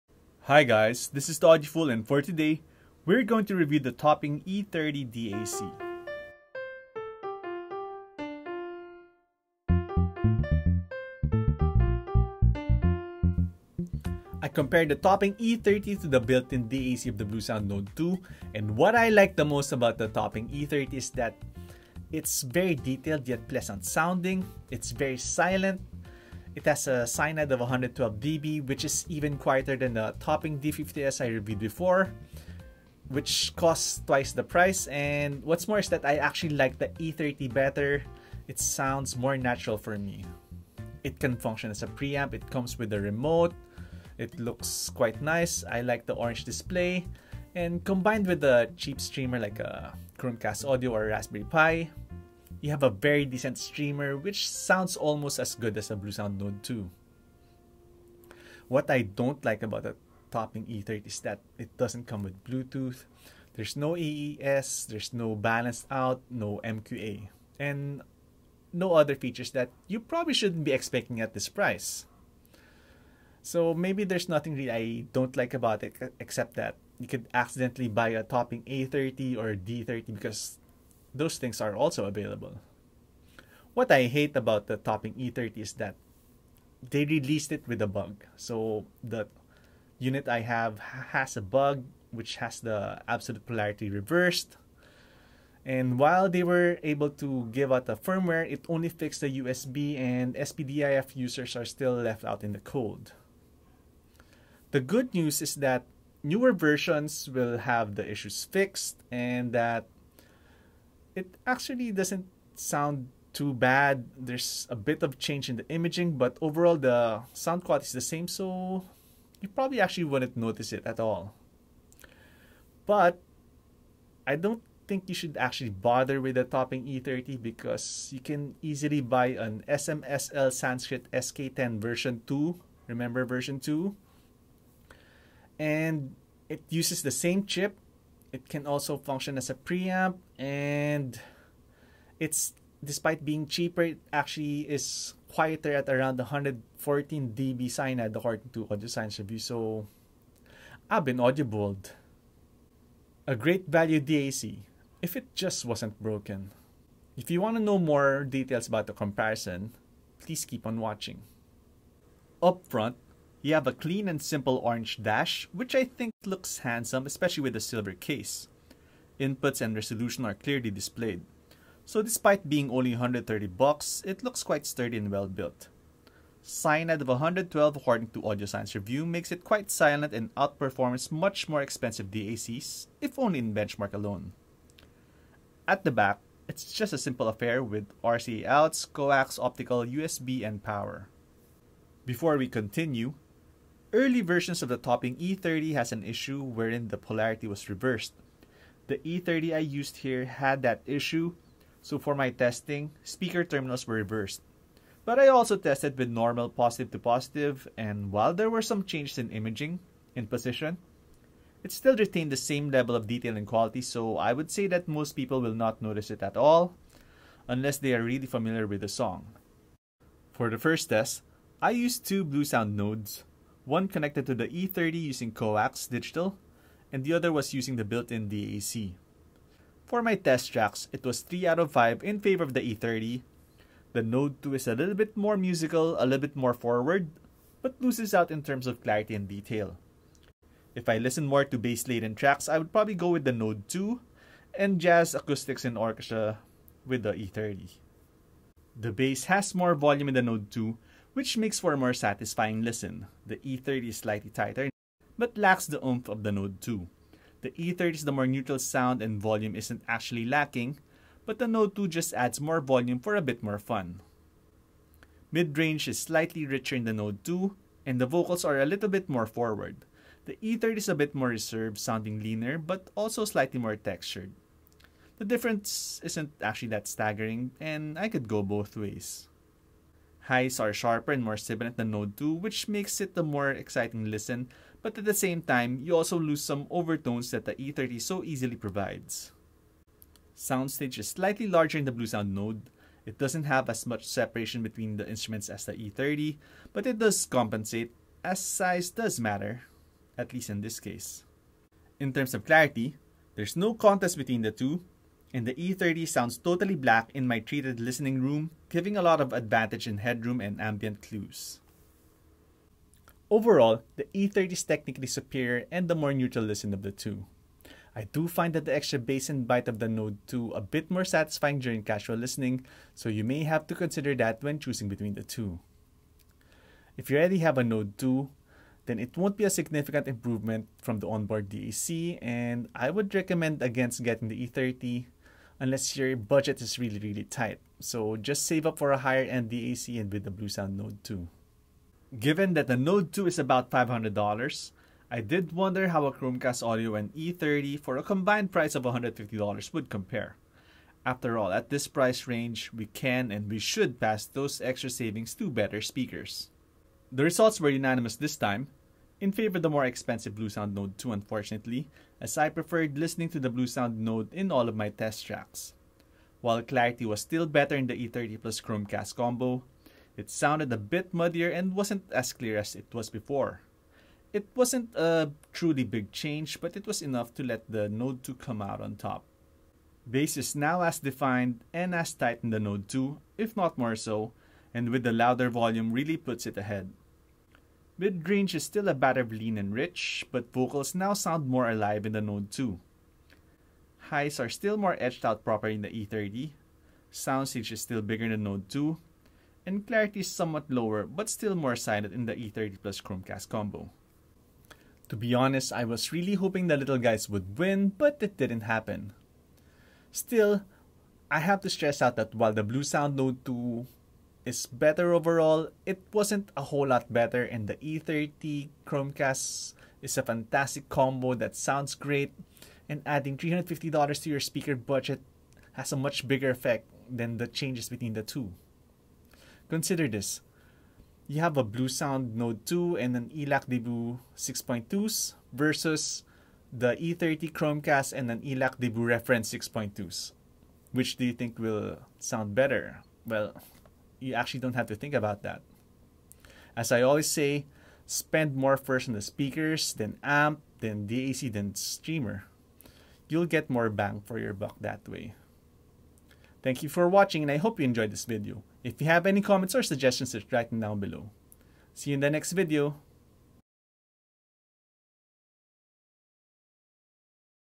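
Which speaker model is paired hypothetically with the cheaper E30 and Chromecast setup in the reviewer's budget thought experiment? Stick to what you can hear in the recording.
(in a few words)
ELAC Debut Reference 6.2.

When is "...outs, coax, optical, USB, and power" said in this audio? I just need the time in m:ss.
3:08.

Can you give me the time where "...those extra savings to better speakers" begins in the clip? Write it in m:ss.
5:54.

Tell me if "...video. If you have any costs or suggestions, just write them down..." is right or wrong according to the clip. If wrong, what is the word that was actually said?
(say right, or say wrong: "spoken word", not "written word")
wrong: "comments", not "costs".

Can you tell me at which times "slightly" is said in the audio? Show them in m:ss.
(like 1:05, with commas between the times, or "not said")
4:13, 4:25, 4:33, 4:51.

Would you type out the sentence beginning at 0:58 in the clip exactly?
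What I don't like about the topping E30 is that it doesn't come with Bluetooth.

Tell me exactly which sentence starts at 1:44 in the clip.
The good news is that newer versions will have the issues fixed and that it actually doesn't sound too bad.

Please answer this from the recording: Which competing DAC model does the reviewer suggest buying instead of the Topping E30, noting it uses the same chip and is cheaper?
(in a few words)
SMSL SK10 version 2.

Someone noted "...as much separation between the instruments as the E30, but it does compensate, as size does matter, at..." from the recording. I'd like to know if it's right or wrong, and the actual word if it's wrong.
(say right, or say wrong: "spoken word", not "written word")
right.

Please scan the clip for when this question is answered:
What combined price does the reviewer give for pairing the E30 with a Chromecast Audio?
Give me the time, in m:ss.
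5:48.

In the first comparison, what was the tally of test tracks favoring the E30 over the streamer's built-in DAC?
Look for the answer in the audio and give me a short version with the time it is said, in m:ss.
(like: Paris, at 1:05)
3 out of 5, at 3:51.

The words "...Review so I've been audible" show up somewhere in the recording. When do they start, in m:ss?
2:29.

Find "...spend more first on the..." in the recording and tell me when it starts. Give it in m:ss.
7:28.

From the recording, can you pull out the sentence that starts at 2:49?
Inputs and resolution are clearly displayed.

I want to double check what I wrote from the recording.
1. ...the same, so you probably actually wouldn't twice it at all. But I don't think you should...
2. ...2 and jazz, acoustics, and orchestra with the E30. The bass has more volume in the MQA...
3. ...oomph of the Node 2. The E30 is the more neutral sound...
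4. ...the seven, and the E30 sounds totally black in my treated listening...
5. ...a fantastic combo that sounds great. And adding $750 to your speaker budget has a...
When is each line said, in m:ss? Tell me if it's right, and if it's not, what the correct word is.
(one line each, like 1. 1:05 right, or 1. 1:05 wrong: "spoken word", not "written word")
1. 1:57 wrong: "notice", not "twice"
2. 4:03 wrong: "Node", not "MQA"
3. 4:15 right
4. 5:04 wrong: "two", not "seven"
5. 7:00 wrong: "350", not "750".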